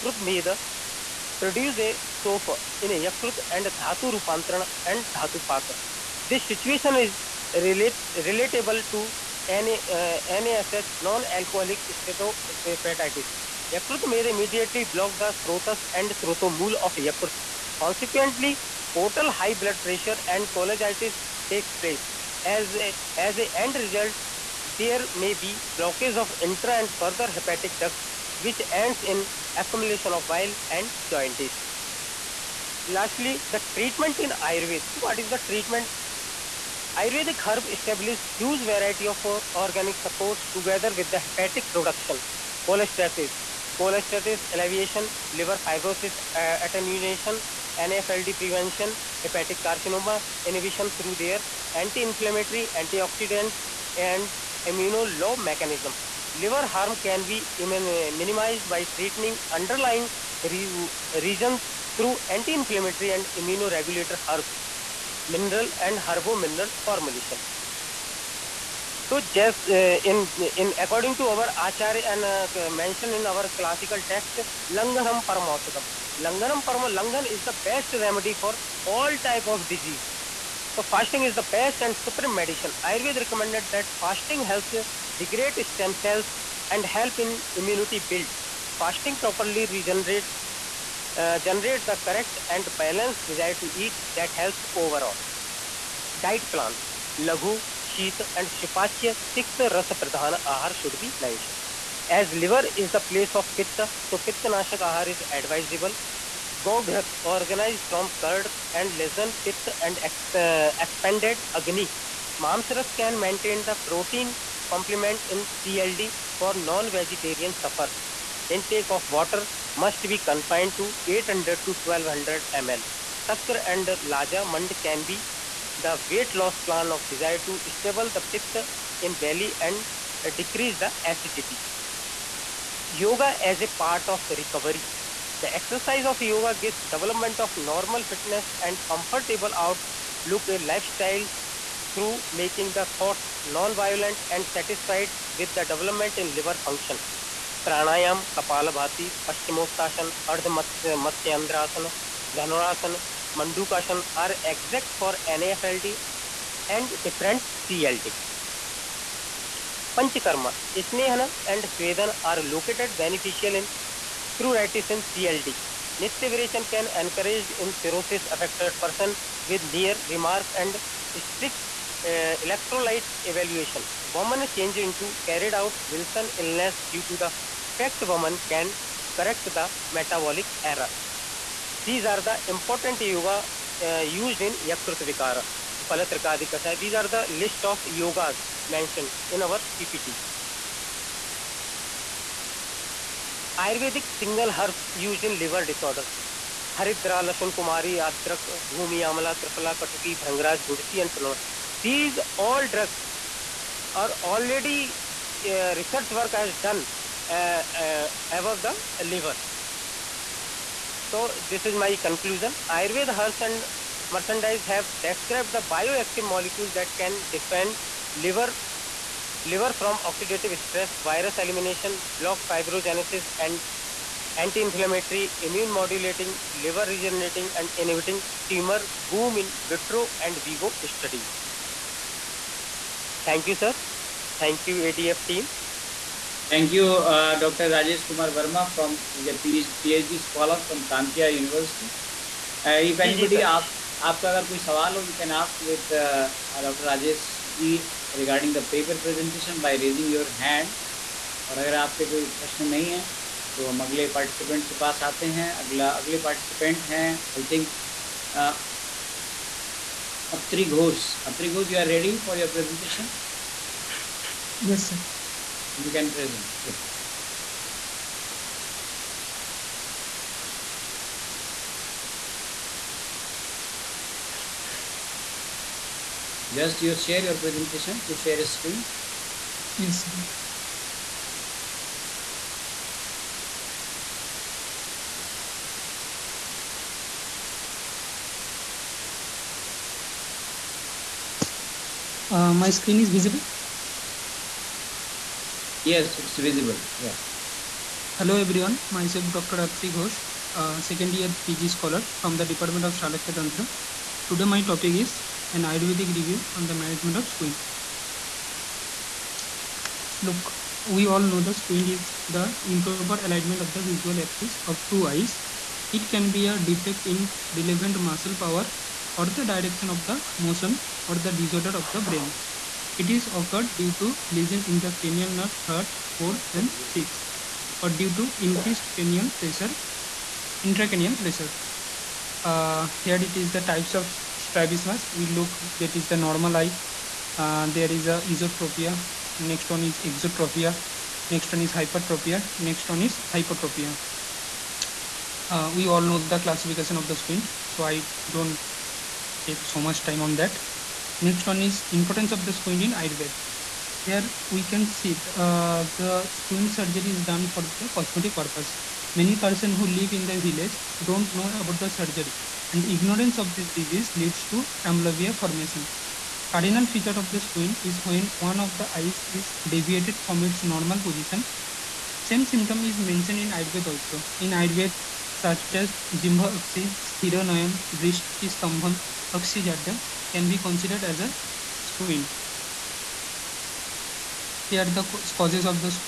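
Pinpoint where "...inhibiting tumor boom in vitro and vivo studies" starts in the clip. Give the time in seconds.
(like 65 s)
227 s.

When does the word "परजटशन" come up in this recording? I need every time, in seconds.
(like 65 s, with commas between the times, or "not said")
249 s, 262 s.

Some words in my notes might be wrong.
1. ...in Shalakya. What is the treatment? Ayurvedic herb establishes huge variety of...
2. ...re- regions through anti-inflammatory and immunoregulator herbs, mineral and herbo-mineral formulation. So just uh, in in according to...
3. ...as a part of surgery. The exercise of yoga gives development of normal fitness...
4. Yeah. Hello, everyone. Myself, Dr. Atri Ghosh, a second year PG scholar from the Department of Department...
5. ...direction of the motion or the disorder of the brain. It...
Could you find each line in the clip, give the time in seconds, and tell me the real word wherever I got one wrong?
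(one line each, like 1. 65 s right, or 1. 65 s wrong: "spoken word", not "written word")
1. 34 s wrong: "Ayurveda", not "Shalakya"
2. 60 s right
3. 133 s wrong: "recovery", not "surgery"
4. 297 s wrong: "Shalakya", not "Department"
5. 319 s right.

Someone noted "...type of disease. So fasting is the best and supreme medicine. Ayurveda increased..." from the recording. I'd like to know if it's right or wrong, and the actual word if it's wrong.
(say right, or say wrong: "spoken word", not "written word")
wrong: "recommended", not "increased".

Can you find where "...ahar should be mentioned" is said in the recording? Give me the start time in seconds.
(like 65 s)
100 s.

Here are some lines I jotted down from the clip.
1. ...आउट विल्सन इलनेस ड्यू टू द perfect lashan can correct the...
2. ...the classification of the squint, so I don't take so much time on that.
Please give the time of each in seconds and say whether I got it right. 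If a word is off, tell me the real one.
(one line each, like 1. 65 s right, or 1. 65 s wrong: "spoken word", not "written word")
1. 175 s wrong: "woman", not "lashan"
2. 346 s right.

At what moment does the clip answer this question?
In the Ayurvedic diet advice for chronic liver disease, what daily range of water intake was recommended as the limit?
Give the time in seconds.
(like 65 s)
121 s.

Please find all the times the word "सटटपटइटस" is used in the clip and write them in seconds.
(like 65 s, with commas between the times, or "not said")
11 s.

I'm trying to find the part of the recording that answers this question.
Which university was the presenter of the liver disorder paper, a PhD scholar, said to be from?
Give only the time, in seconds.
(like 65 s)
240 s.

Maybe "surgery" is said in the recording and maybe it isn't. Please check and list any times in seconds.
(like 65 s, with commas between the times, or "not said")
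356 s, 361 s.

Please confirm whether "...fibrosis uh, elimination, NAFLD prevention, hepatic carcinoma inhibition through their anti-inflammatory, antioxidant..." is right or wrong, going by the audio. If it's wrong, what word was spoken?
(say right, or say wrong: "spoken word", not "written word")
wrong: "attenuation", not "elimination".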